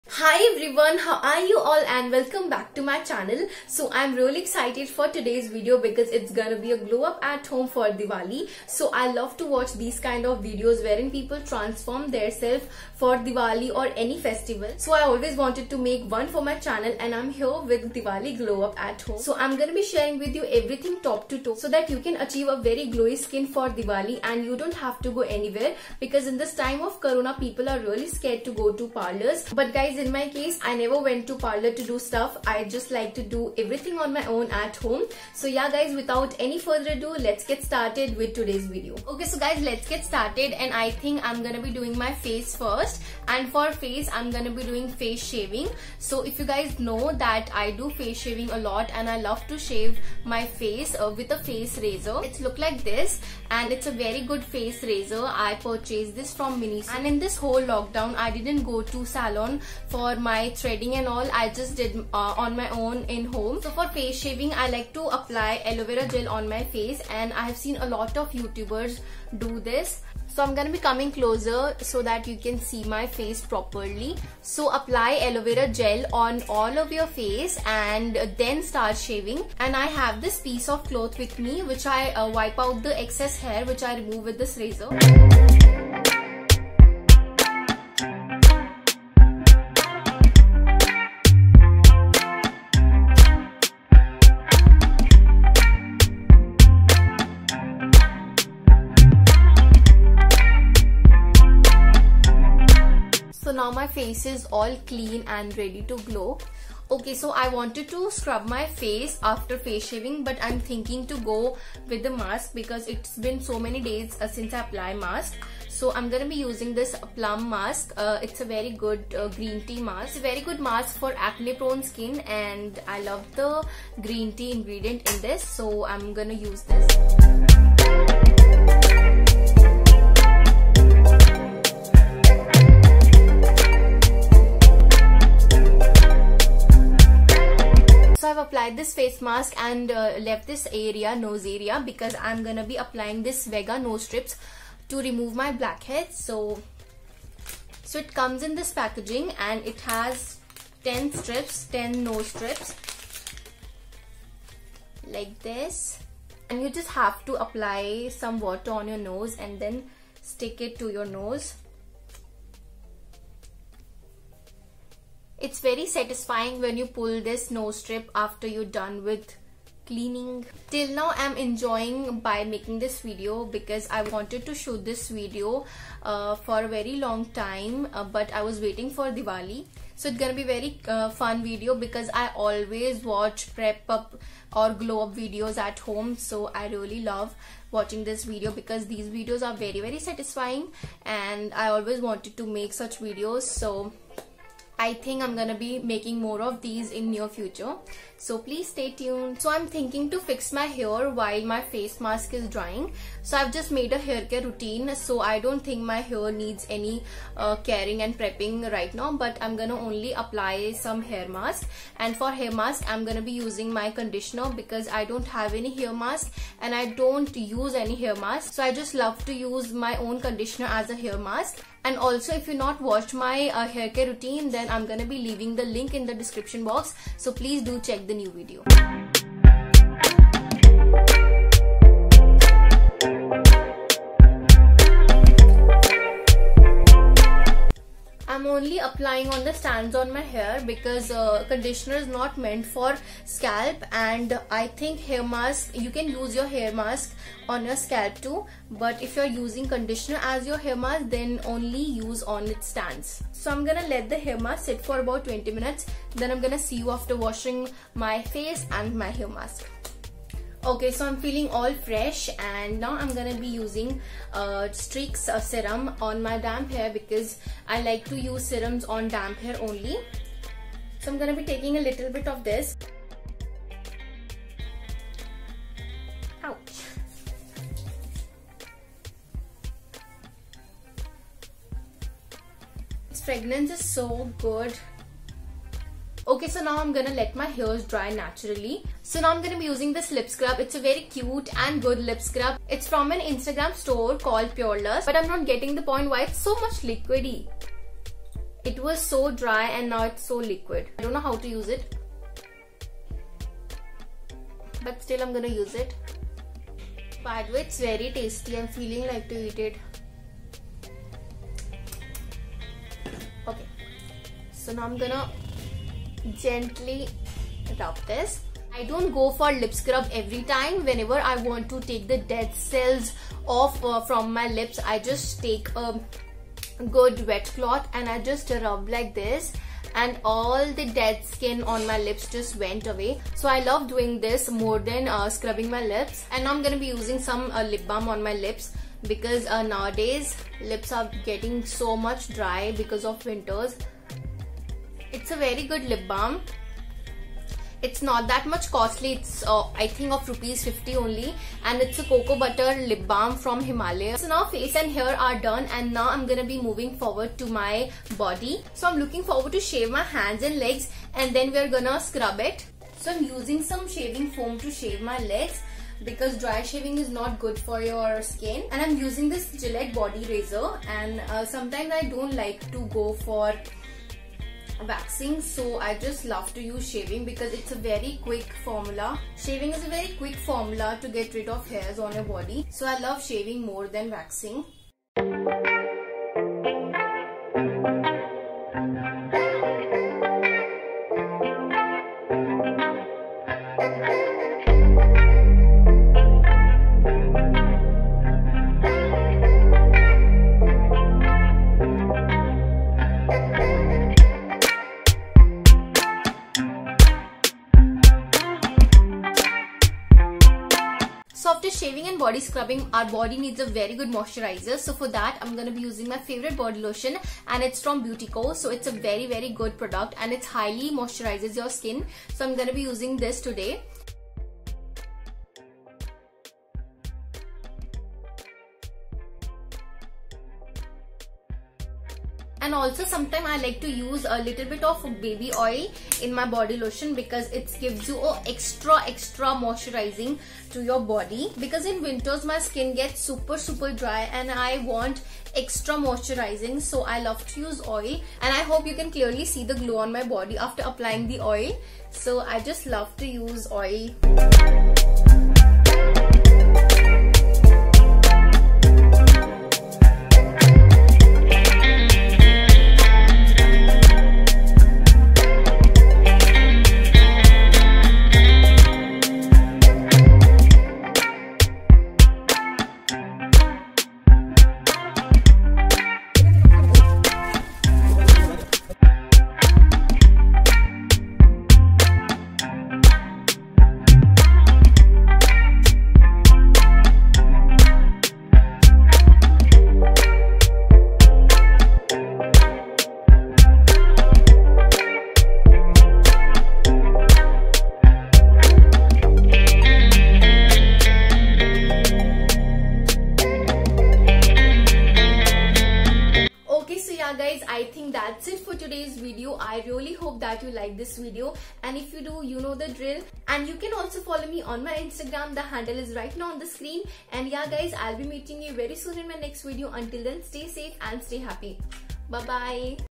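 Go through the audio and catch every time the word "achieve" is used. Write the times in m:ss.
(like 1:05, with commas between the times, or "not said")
0:22.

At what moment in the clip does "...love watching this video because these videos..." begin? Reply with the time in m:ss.
3:07.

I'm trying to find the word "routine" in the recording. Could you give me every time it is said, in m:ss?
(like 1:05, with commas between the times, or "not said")
3:24, 3:44.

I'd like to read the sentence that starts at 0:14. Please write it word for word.
So I always wanted to make one for my channel and I'm here with Diwali glow up at home.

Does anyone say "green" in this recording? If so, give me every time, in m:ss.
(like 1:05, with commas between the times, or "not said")
1:59, 2:04.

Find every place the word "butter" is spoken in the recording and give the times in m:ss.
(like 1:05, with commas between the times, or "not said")
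5:52.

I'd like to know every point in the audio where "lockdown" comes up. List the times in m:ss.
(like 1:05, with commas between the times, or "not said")
0:57.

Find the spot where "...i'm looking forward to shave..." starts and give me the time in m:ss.
5:58.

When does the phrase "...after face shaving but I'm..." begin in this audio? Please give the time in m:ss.
1:49.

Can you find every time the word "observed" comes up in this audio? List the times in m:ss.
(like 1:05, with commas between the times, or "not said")
not said.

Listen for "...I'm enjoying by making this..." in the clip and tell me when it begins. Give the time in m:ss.
2:51.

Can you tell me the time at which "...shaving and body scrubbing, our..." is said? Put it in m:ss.
6:51.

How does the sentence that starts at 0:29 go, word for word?
But guys in my case, I never went to parlor to do stuff.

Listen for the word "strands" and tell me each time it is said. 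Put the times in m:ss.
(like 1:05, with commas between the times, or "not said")
3:59.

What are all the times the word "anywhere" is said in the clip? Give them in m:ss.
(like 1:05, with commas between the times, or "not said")
0:25.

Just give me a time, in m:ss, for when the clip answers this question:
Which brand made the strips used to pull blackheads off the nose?
2:23.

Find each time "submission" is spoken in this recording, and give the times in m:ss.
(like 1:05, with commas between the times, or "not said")
not said.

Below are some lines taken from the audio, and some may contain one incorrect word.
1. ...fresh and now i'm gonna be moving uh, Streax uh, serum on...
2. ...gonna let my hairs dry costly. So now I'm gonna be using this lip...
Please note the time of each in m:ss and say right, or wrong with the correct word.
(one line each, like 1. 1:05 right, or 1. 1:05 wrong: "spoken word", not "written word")
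1. 4:21 wrong: "using", not "moving"
2. 4:46 wrong: "naturally", not "costly".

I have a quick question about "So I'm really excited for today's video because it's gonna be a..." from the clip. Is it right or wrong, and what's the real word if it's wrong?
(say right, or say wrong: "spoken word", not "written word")
right.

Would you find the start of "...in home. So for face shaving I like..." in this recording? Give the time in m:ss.
1:03.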